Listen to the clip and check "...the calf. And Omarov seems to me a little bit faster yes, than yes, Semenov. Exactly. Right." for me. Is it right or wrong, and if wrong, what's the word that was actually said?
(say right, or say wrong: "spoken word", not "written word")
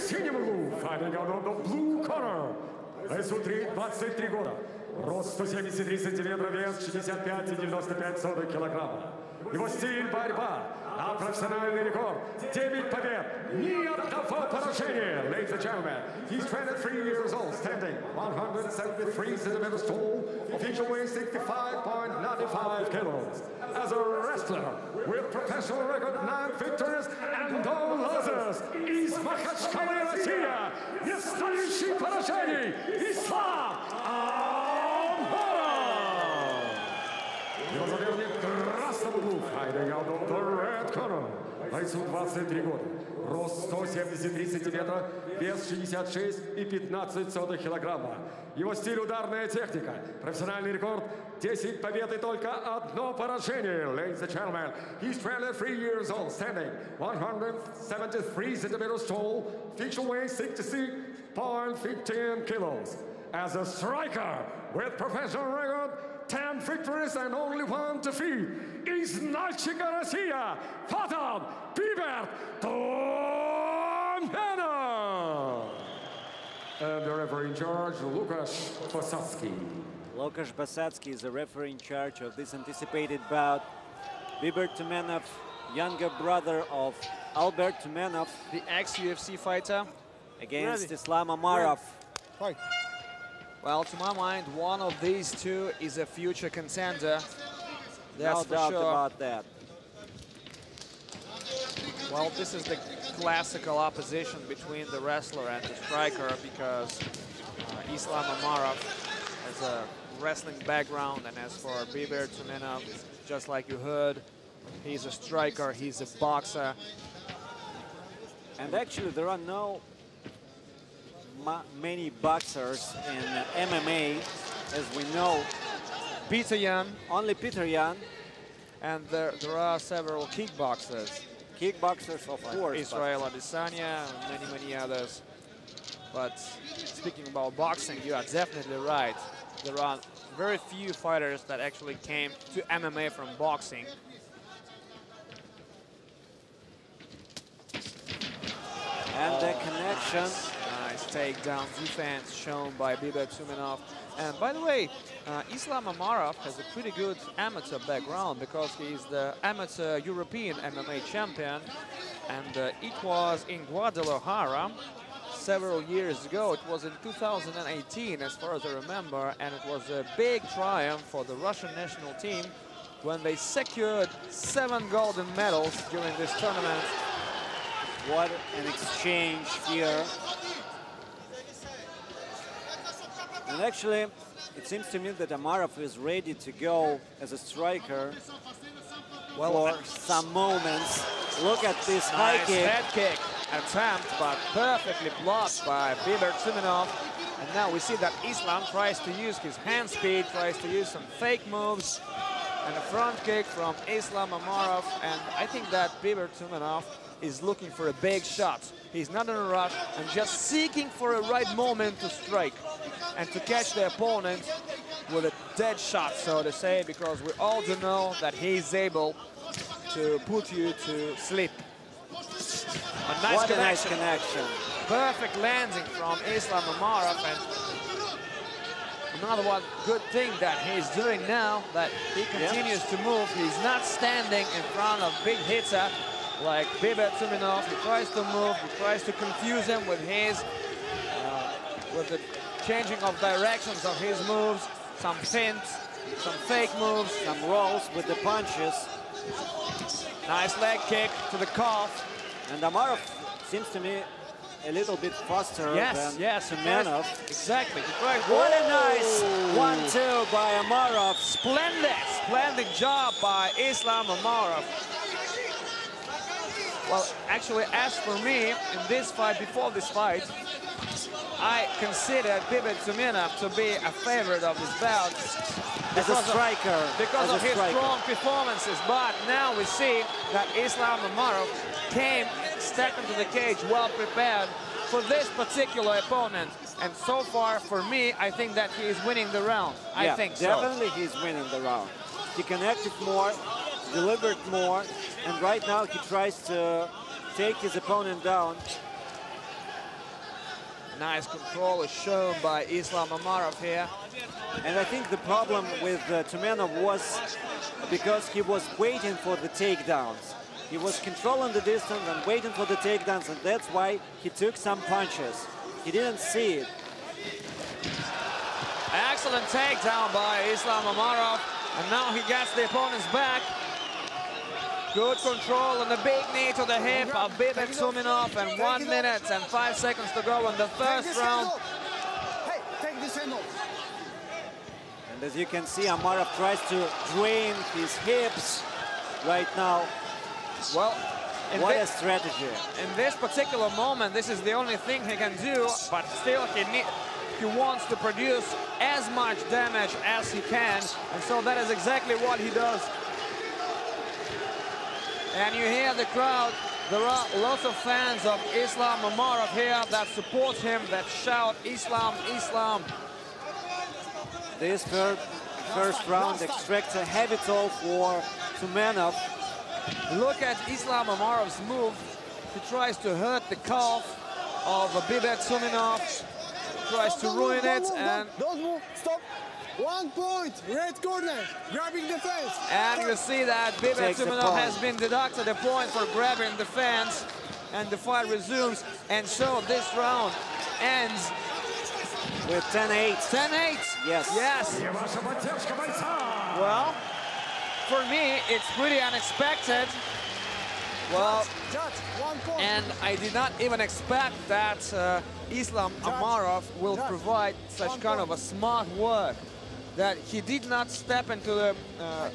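right.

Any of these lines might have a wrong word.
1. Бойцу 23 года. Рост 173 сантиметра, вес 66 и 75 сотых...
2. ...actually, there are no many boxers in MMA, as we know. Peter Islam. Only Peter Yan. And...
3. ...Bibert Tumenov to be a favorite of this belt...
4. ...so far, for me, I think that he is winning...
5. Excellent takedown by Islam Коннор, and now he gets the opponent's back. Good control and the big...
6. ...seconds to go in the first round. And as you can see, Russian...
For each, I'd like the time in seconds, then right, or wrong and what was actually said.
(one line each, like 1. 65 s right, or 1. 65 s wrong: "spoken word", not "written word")
1. 41 s wrong: "15", not "75"
2. 118 s wrong: "Yan", not "Islam"
3. 272 s right
4. 286 s right
5. 319 s wrong: "Omarov", not "Коннор"
6. 329 s wrong: "Omarov", not "Russian".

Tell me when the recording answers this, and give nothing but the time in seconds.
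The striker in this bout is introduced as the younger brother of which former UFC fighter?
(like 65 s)
87 s.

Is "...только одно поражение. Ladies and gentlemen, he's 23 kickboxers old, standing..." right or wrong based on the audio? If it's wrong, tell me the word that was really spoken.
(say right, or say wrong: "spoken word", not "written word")
wrong: "years", not "kickboxers".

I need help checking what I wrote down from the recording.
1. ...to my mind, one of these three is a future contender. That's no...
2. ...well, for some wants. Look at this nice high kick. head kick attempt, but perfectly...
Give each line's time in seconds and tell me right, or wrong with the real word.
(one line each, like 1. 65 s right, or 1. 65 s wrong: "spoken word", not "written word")
1. 93 s wrong: "two", not "three"
2. 189 s wrong: "moments", not "wants".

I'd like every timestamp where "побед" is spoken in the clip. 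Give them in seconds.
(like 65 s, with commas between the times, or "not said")
12 s, 51 s.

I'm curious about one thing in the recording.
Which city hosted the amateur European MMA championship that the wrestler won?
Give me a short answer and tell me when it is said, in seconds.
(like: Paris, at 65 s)
Guadalajara, at 163 s.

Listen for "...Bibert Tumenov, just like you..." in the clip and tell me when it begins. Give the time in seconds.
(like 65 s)
111 s.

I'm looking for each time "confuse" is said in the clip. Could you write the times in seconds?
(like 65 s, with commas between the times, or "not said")
239 s.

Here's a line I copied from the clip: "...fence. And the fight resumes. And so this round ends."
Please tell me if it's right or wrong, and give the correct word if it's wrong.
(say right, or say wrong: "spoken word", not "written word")
right.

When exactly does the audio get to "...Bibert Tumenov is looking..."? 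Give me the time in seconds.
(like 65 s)
206 s.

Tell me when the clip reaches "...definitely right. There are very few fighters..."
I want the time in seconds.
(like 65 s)
138 s.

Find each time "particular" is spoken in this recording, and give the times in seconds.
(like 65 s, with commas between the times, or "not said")
285 s, 343 s.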